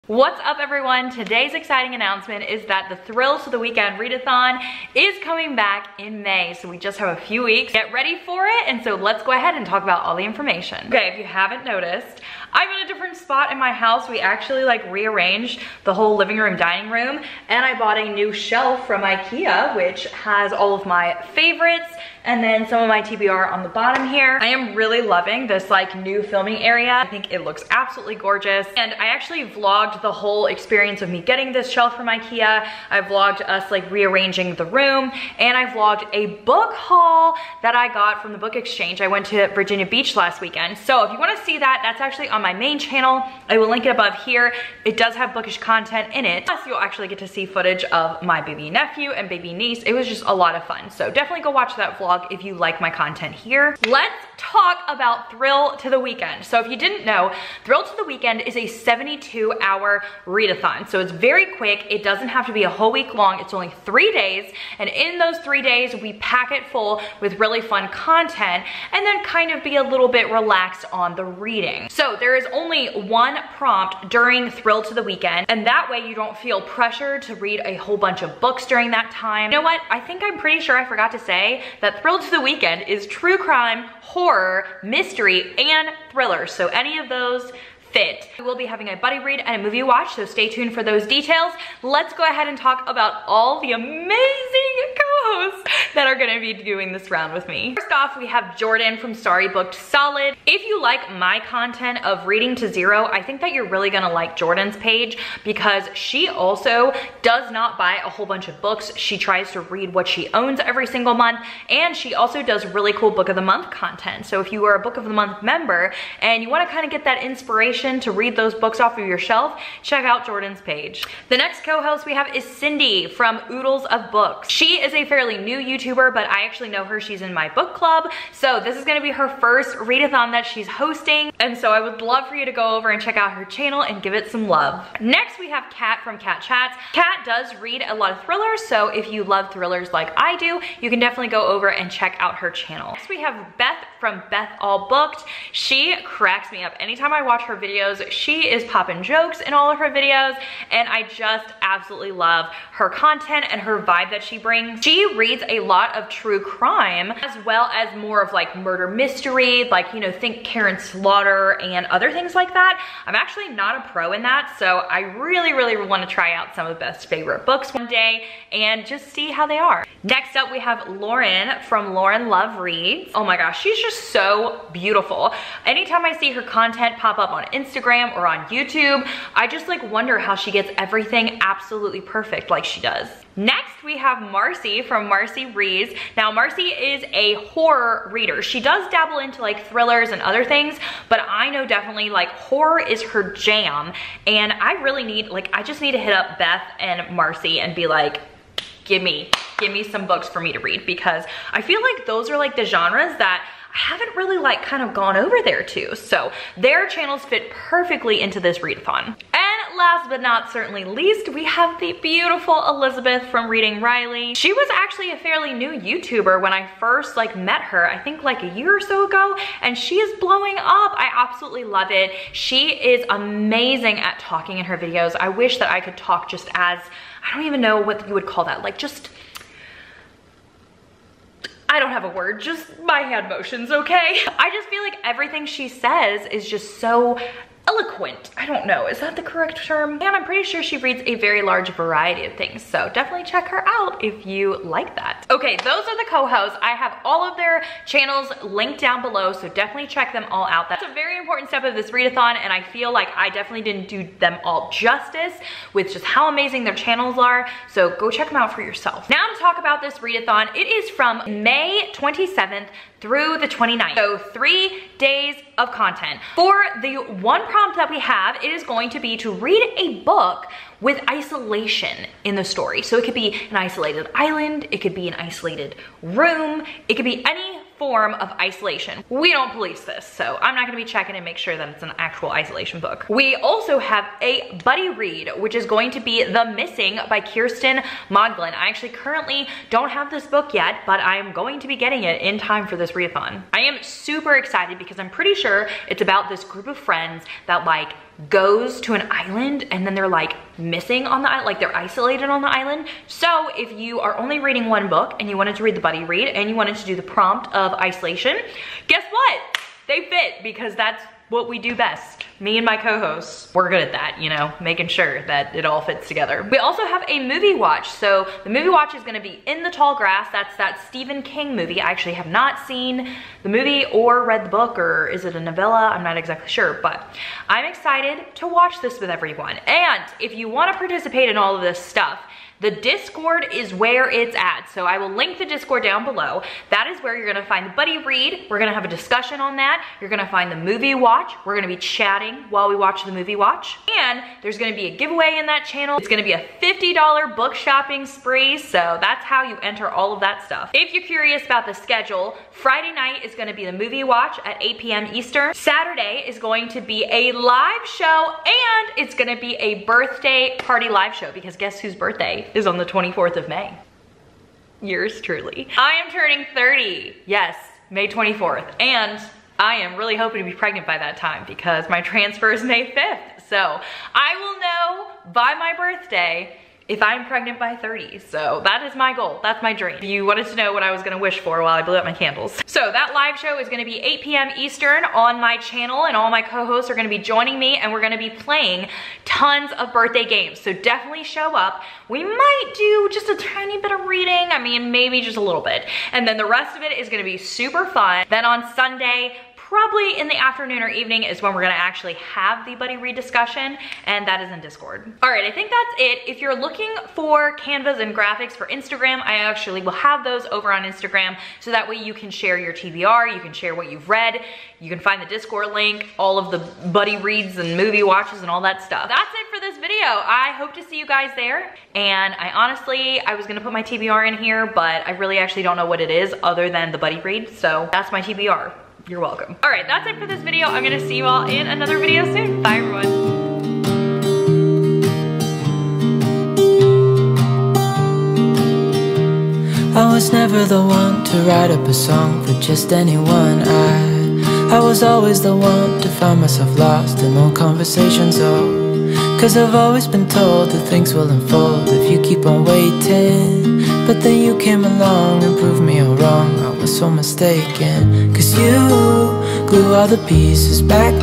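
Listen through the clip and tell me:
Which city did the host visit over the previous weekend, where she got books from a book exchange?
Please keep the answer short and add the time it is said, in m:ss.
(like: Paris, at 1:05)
Virginia Beach, at 0:39.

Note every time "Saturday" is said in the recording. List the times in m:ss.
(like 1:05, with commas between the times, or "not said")
5:55.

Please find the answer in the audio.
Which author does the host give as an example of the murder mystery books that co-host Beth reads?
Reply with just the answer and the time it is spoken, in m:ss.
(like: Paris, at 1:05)
Karin Slaughter, at 2:40.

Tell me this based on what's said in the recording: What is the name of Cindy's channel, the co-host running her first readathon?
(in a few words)
Oodles of Books.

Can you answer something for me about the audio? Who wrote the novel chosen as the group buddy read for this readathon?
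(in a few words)
Kiersten Modglin.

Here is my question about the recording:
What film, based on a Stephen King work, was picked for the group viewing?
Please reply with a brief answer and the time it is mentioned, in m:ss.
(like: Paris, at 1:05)
In the Tall Grass, at 5:19.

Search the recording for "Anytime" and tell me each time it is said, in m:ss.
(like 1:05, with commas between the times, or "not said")
2:26, 2:55.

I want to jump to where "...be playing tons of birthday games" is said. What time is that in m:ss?
6:28.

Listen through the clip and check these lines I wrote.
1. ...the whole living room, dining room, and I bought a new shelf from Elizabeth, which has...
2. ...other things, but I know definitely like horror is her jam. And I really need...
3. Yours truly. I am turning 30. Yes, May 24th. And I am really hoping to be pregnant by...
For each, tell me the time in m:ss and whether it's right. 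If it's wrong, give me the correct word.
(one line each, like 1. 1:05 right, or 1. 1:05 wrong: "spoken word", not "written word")
1. 0:15 wrong: "Ikea", not "Elizabeth"
2. 3:10 right
3. 6:04 right.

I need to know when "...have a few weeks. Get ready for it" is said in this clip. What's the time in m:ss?
0:06.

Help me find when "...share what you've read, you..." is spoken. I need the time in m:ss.
6:53.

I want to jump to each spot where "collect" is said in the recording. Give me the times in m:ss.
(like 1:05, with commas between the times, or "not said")
not said.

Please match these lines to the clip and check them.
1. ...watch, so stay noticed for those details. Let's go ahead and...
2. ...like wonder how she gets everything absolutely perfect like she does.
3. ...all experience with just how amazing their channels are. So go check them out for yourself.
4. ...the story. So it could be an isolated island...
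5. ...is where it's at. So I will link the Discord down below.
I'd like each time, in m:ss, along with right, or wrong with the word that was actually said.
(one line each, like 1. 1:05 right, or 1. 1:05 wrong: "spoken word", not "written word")
1. 1:29 wrong: "tuned", not "noticed"
2. 2:59 right
3. 4:14 wrong: "justice", not "experience"
4. 4:32 right
5. 5:33 right.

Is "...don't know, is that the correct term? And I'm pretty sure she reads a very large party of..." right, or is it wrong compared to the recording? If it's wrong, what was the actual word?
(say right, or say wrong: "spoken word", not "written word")
wrong: "variety", not "party".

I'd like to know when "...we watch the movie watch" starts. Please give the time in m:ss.
5:42.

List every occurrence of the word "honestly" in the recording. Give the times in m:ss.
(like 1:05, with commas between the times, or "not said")
7:02.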